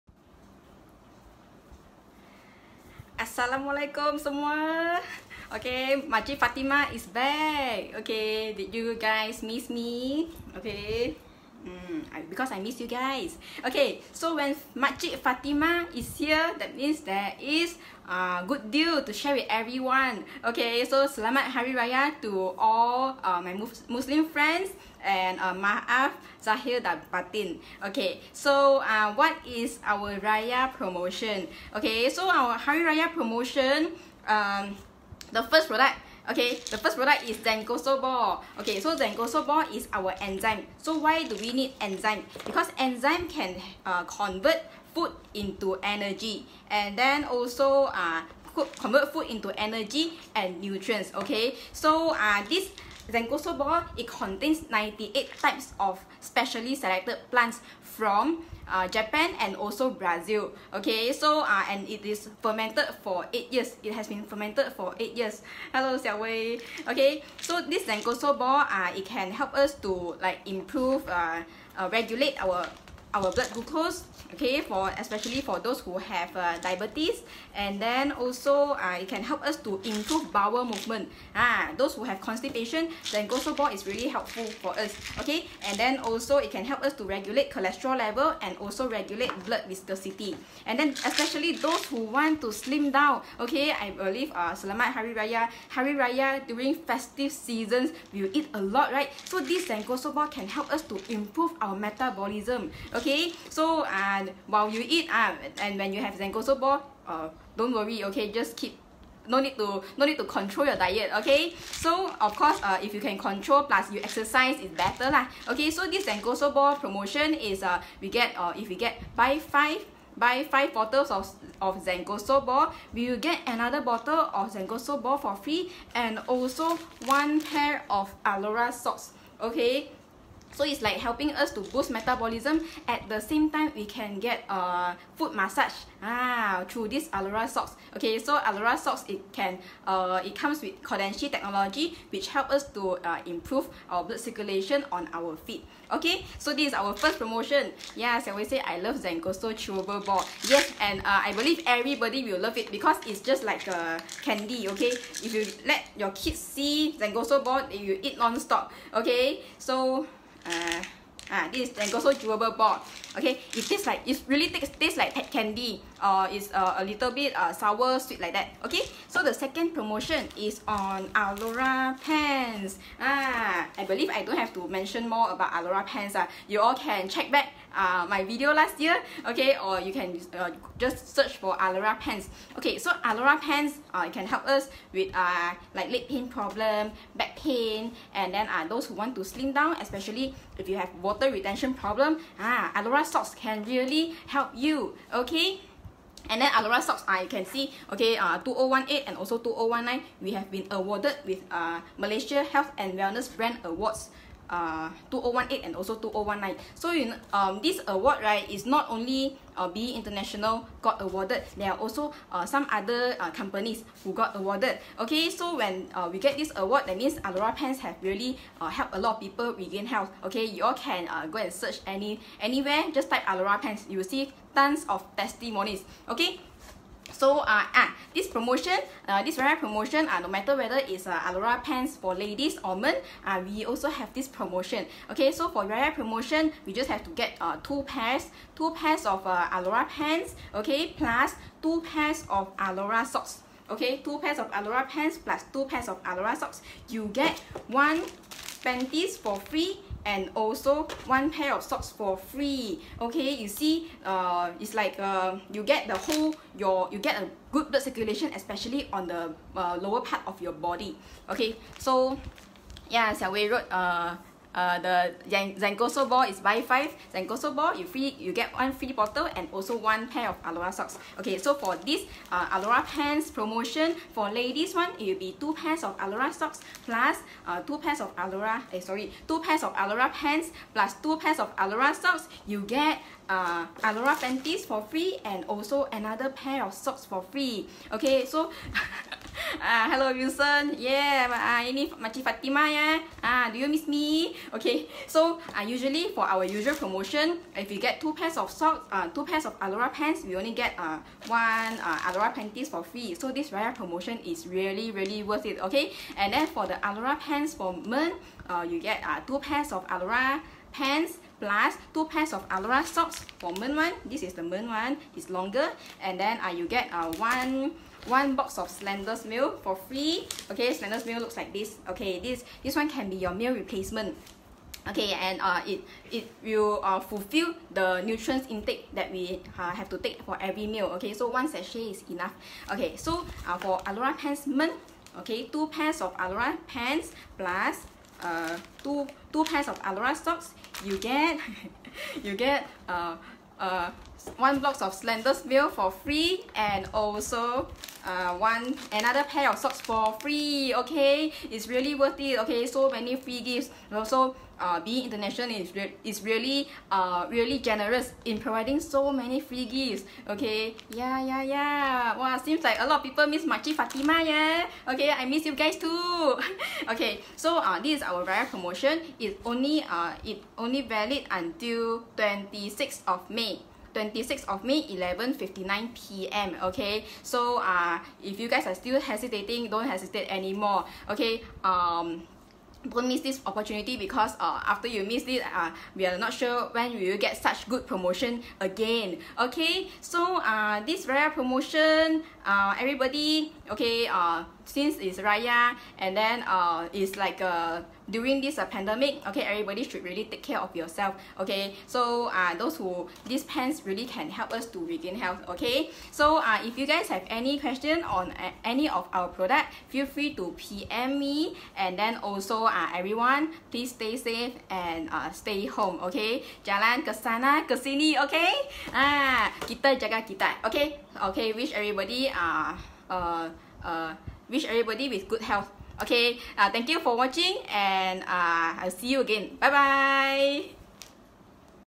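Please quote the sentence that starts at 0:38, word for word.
Okay, so Zencoso ball is our enzyme.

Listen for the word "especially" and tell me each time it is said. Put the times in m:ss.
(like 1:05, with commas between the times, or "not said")
1:14, 1:31, 3:09, 4:18.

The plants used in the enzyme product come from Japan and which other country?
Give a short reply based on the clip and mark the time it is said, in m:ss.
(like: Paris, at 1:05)
Brazil, at 0:59.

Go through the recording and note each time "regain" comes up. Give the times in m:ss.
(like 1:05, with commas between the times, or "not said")
3:39, 6:44.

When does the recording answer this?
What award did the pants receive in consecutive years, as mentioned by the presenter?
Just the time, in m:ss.
3:21.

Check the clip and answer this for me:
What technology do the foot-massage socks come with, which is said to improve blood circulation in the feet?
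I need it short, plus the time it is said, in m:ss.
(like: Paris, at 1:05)
Kodenshi technology, at 2:20.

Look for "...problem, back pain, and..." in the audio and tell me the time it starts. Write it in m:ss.
3:06.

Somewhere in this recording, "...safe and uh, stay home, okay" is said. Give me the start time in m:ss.
6:54.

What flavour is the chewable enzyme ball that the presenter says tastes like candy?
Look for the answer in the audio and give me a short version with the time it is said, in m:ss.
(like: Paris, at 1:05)
mango, at 2:41.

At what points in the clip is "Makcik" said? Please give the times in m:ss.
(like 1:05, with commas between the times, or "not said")
0:06, 0:14, 4:51, 6:03.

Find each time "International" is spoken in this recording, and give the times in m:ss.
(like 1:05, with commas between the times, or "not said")
3:29, 5:55.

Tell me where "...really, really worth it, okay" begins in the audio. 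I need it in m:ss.
5:04.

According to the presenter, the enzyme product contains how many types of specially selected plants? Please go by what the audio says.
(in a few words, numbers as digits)
98.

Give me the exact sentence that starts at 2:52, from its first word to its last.
Ah, I believe I don't have to mention more about Aulora pants.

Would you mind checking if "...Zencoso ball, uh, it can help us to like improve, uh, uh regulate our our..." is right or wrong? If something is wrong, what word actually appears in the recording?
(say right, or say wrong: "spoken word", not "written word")
right.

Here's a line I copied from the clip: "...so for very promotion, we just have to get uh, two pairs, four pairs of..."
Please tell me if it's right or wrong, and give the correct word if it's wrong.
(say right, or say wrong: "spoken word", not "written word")
wrong: "two", not "four".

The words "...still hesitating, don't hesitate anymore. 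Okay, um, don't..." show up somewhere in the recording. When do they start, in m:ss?
6:18.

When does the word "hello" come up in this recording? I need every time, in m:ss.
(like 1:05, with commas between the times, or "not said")
1:05, 4:49.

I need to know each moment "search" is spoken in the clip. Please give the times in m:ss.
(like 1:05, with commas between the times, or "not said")
3:01, 3:41.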